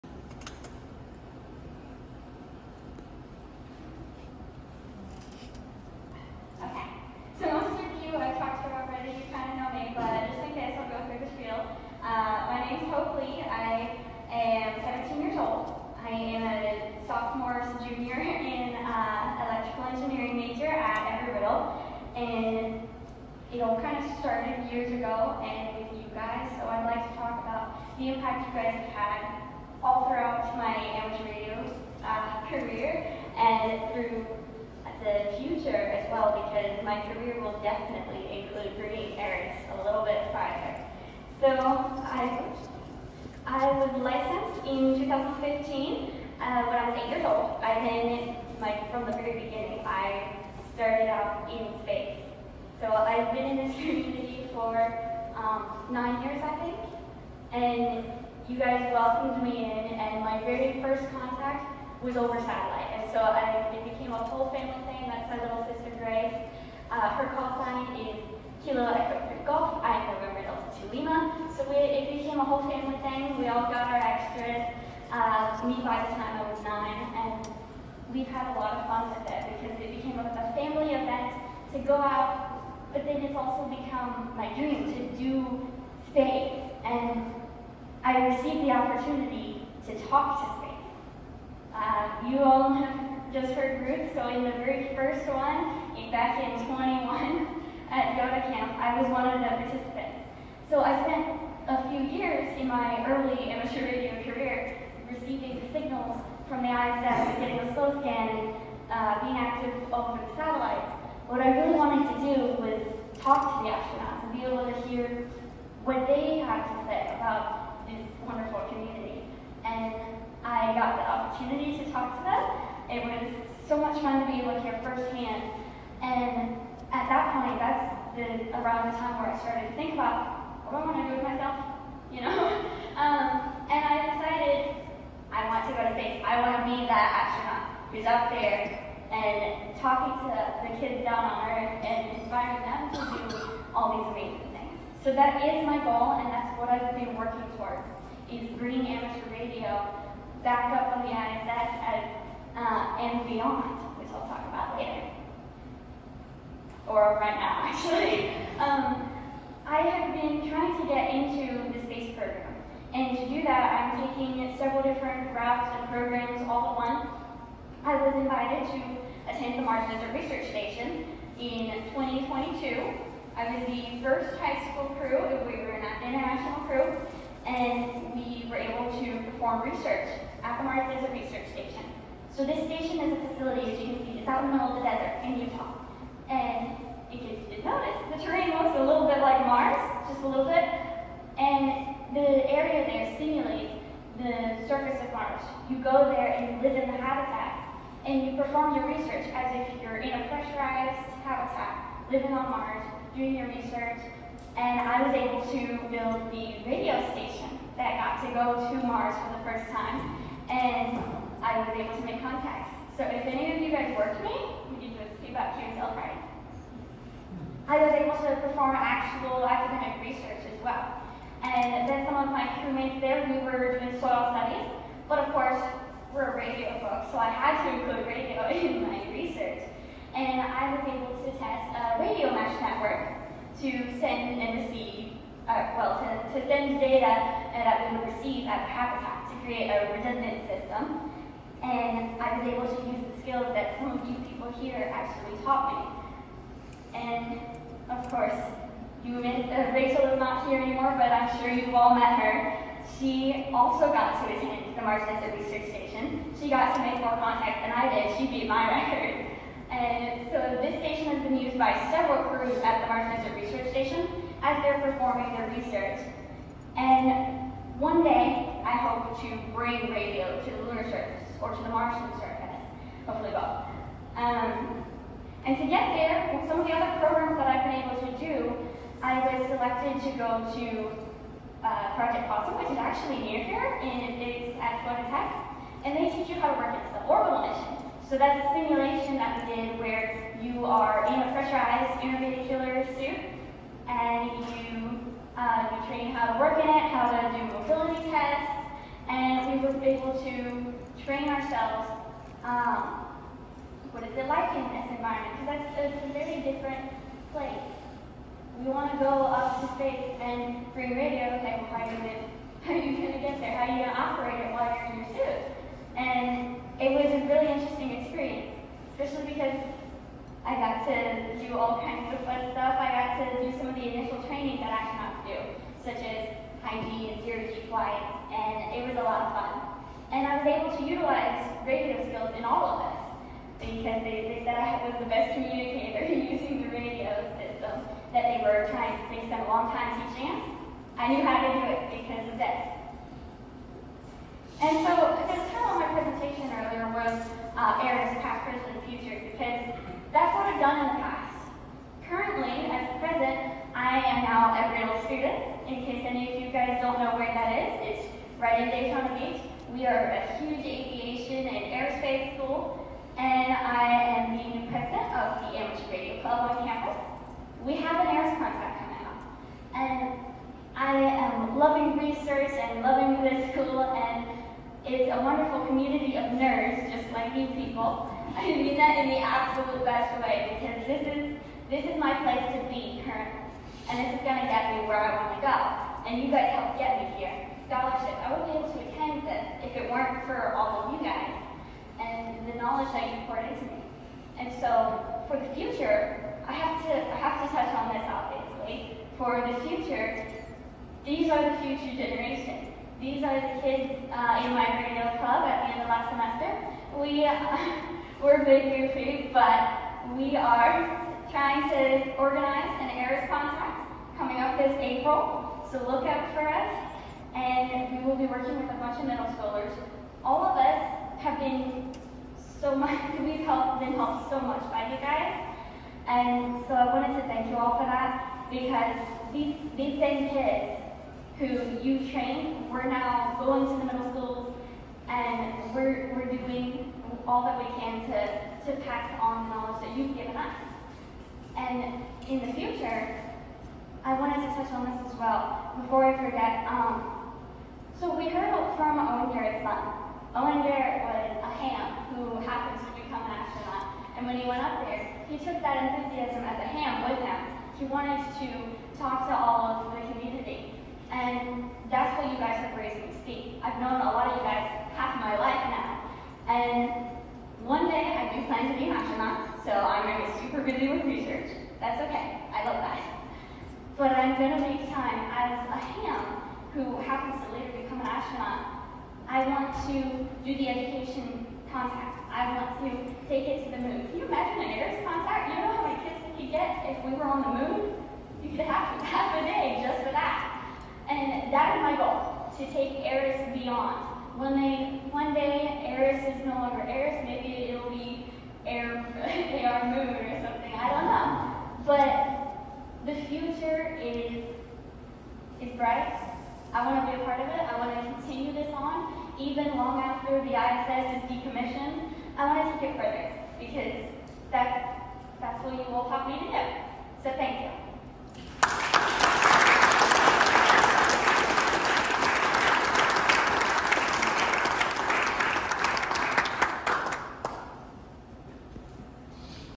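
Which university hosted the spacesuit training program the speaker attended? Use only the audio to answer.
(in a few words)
Florida Tech.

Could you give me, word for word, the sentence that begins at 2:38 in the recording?
Um, I have been trying to get into the space program.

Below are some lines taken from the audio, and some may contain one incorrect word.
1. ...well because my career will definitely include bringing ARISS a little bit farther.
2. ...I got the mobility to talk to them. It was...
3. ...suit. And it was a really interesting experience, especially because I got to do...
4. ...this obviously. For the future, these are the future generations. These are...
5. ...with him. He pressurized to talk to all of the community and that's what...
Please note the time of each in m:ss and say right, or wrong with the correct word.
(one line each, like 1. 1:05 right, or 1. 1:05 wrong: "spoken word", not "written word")
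1. 0:36 right
2. 2:00 wrong: "opportunity", not "mobility"
3. 5:15 right
4. 6:37 right
5. 7:37 wrong: "wanted", not "pressurized".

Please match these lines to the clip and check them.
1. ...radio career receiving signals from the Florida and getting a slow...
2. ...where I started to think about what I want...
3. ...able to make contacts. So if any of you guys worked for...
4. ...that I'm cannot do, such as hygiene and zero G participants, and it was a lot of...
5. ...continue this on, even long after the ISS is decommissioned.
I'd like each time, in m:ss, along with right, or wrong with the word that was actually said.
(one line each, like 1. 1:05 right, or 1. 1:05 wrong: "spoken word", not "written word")
1. 1:43 wrong: "ISS", not "Florida"
2. 2:09 right
3. 3:31 right
4. 5:24 wrong: "flights", not "participants"
5. 8:28 right.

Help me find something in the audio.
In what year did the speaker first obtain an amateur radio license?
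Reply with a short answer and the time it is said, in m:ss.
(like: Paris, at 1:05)
2015, at 0:44.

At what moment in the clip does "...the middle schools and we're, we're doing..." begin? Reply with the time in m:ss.
7:13.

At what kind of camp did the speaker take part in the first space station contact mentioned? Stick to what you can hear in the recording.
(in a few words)
YOTA Camp.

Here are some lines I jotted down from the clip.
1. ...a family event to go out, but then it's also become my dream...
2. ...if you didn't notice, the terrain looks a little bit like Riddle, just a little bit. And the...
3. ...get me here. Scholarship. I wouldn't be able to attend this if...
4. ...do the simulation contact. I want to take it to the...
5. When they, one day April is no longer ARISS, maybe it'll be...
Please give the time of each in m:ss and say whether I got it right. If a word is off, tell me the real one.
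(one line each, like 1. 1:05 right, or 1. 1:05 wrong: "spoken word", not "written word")
1. 1:20 right
2. 3:07 wrong: "Mars", not "Riddle"
3. 6:26 right
4. 8:00 wrong: "education", not "simulation"
5. 8:14 wrong: "ARISS", not "April".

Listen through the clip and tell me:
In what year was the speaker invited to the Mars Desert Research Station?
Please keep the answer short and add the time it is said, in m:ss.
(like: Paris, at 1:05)
2022, at 2:51.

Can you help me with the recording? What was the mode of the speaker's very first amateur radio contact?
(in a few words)
Satellite.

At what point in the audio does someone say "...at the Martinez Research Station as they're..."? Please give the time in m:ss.
4:22.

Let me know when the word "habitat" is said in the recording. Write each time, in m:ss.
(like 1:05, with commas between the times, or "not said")
3:17, 3:21, 3:58.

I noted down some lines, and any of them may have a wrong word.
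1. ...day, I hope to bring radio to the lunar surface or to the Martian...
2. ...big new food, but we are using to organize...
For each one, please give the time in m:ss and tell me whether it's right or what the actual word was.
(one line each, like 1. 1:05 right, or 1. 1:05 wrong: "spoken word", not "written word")
1. 4:28 right
2. 6:48 wrong: "trying", not "using".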